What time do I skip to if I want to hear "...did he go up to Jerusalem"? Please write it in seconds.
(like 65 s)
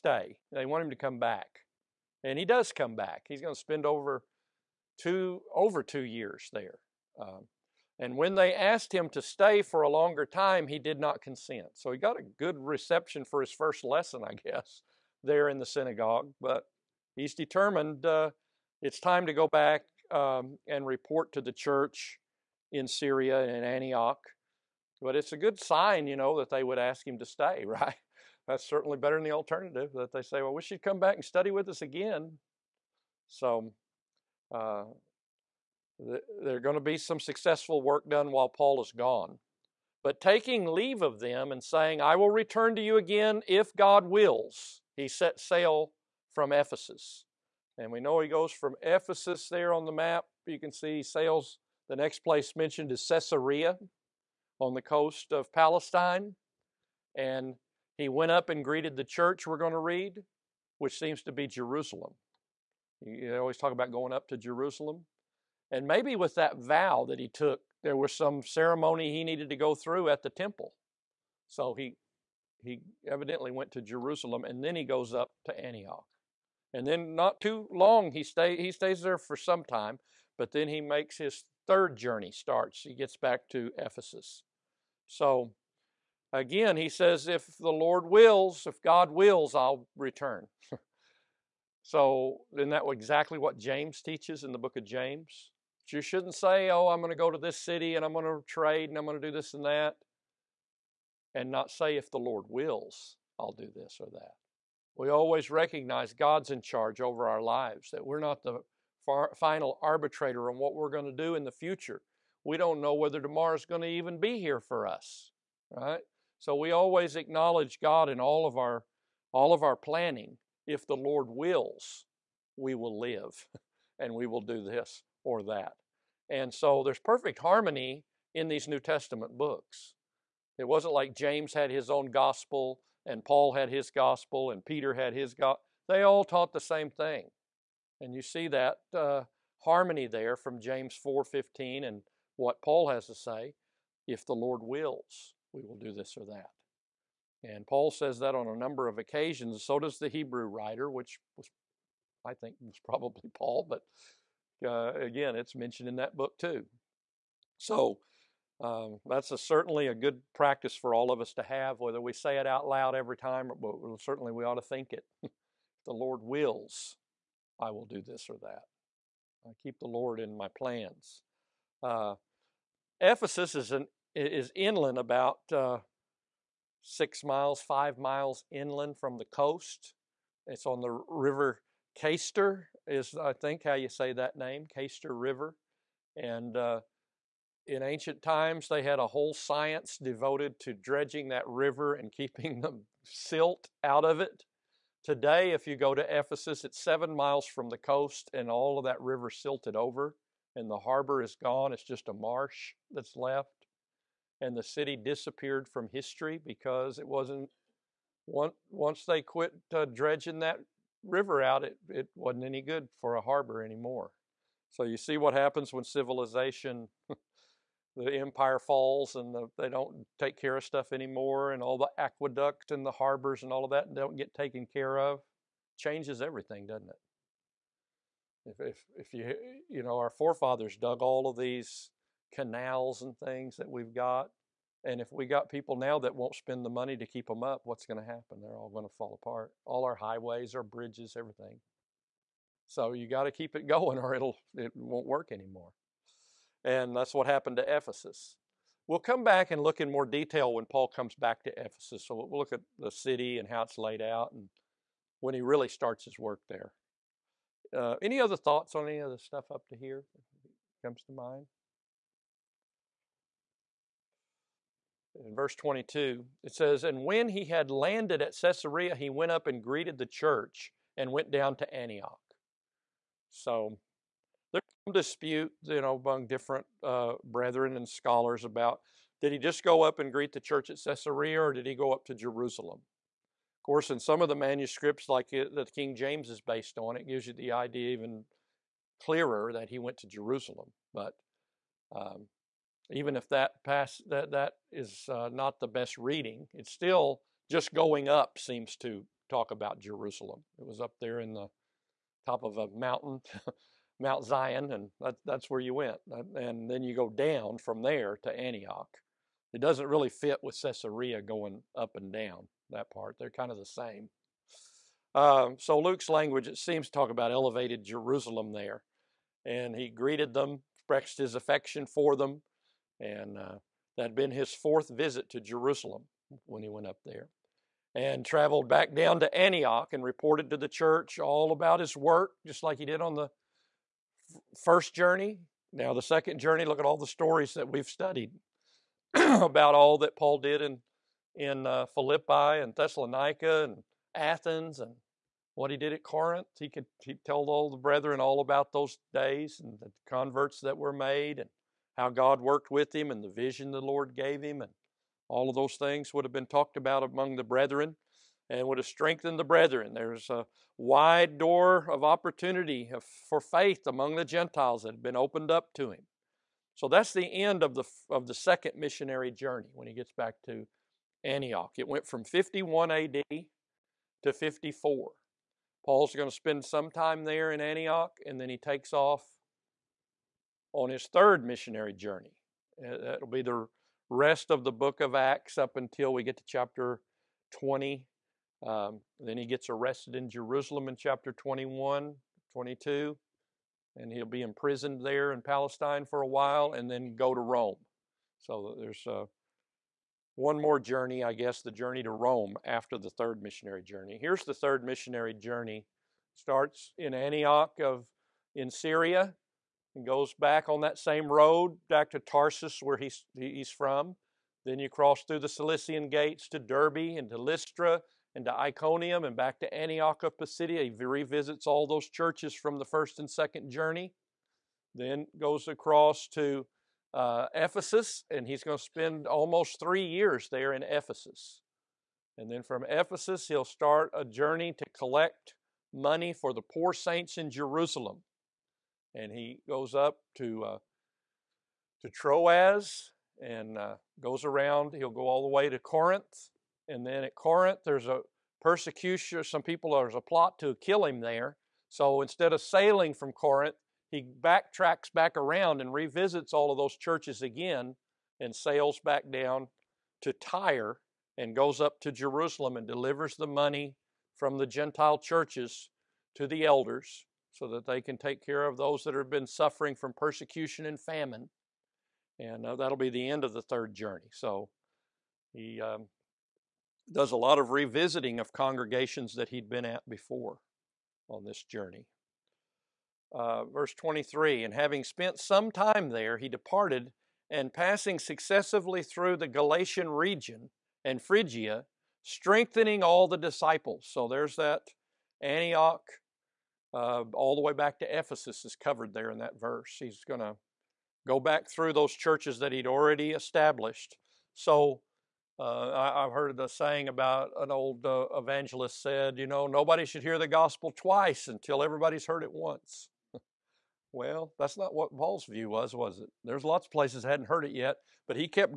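281 s.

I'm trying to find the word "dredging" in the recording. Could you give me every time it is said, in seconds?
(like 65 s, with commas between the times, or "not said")
190 s, 209 s.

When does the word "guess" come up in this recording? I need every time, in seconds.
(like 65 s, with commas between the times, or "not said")
14 s, 401 s.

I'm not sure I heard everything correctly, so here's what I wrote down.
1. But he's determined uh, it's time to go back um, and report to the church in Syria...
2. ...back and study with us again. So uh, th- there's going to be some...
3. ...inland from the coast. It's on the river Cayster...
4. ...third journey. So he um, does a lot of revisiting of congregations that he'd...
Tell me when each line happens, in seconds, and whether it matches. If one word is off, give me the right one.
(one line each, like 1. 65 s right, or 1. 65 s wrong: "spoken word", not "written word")
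1. 16 s right
2. 30 s right
3. 178 s right
4. 473 s right.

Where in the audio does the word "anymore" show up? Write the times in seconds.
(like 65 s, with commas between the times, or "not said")
213 s, 220 s, 245 s.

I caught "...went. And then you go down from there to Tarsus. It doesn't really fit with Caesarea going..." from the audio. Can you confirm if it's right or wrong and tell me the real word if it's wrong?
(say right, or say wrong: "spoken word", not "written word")
wrong: "Antioch", not "Tarsus".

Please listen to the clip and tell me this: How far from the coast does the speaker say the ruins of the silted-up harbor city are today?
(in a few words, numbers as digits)
7 miles.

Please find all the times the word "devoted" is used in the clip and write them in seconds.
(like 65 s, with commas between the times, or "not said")
190 s.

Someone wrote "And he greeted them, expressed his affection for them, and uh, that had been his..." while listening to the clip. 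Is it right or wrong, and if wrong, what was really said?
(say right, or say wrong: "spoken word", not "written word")
right.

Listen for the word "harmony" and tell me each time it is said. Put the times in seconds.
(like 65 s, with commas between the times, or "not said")
127 s, 139 s.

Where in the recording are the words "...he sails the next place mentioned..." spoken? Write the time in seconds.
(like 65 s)
50 s.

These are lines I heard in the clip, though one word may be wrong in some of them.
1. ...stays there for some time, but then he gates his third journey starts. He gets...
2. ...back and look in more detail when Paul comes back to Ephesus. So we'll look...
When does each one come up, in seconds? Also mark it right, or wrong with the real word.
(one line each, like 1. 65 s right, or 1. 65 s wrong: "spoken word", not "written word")
1. 78 s wrong: "makes", not "gates"
2. 249 s right.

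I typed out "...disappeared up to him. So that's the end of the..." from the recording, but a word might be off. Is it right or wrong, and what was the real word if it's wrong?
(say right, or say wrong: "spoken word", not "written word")
wrong: "opened", not "disappeared".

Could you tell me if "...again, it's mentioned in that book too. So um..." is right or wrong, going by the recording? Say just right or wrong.
right.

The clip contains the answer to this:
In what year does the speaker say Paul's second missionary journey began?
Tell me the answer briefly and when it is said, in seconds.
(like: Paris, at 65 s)
51 AD, at 372 s.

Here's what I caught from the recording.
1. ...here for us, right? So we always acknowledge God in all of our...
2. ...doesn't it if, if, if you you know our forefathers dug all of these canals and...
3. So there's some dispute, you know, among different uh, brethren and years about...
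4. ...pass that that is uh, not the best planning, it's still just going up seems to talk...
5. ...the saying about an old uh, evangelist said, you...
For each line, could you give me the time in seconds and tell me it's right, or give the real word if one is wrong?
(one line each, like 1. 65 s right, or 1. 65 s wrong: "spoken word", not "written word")
1. 114 s right
2. 226 s right
3. 273 s wrong: "scholars", not "years"
4. 293 s wrong: "reading", not "planning"
5. 506 s right.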